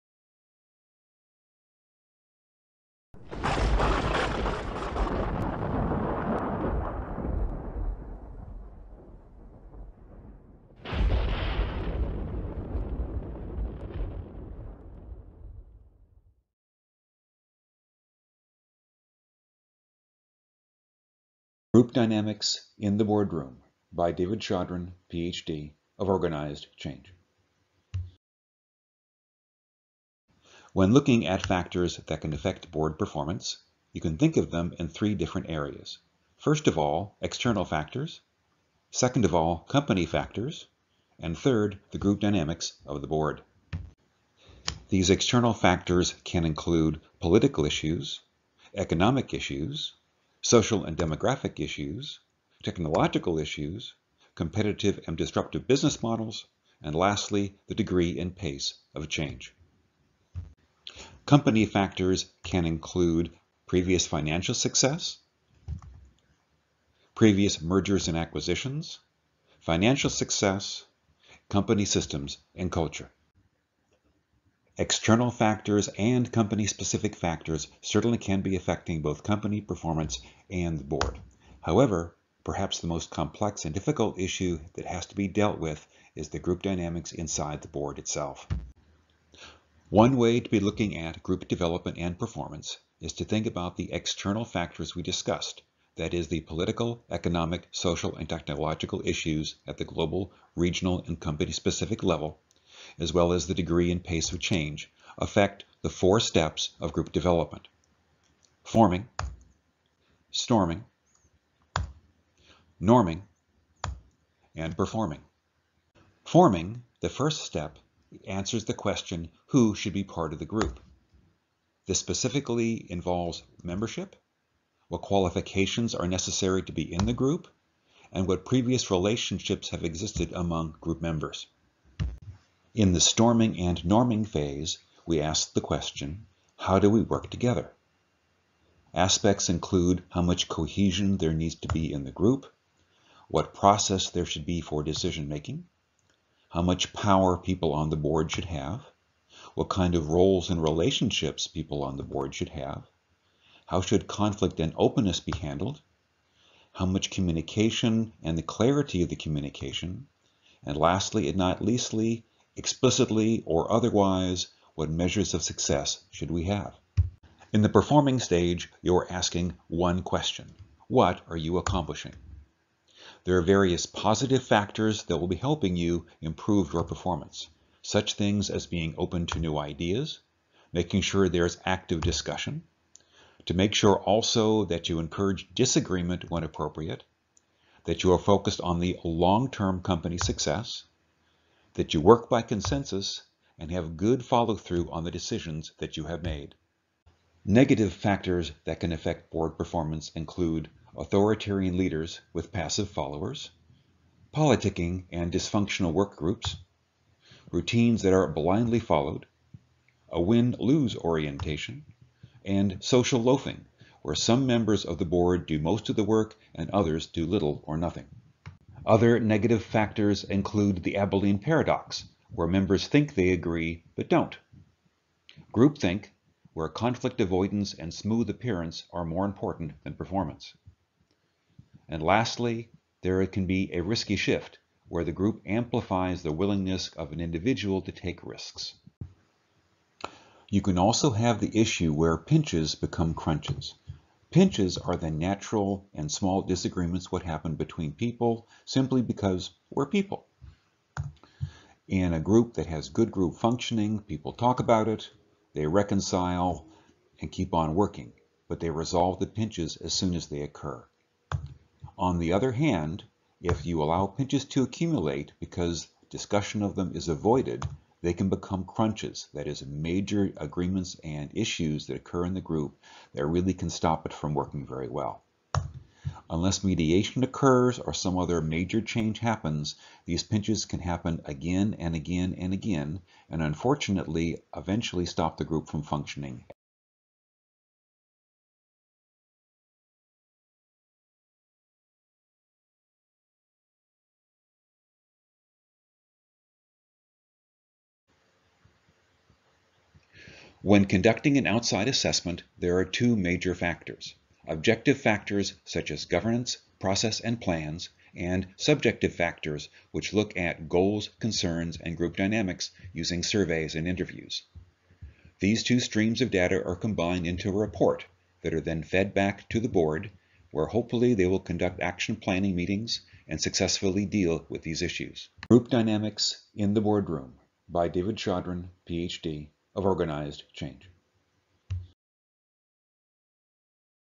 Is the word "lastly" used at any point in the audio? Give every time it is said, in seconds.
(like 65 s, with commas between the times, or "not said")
56 s, 160 s, 232 s.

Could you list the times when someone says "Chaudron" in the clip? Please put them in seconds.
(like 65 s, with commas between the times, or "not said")
24 s, 328 s.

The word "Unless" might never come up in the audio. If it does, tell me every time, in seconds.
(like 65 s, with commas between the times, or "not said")
276 s.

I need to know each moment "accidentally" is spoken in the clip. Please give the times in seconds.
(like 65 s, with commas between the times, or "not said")
not said.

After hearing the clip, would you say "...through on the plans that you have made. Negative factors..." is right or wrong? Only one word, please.
wrong.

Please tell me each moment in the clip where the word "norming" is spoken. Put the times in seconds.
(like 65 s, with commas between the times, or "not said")
112 s, 133 s.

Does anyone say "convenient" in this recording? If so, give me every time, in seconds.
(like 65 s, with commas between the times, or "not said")
not said.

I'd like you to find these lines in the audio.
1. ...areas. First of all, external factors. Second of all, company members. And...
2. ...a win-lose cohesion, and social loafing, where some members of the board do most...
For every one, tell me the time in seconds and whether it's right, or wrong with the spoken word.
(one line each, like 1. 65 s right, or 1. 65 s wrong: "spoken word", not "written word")
1. 35 s wrong: "factors", not "members"
2. 210 s wrong: "orientation", not "cohesion".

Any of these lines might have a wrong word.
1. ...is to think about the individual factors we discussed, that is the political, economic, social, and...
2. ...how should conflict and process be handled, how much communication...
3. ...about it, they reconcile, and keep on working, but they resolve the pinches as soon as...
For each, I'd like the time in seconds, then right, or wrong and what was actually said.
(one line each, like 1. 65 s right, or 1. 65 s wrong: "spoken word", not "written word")
1. 92 s wrong: "external", not "individual"
2. 153 s wrong: "openness", not "process"
3. 254 s right.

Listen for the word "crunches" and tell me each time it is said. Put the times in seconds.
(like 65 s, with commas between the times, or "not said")
243 s, 268 s.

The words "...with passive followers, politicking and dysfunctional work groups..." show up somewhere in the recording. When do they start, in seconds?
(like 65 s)
202 s.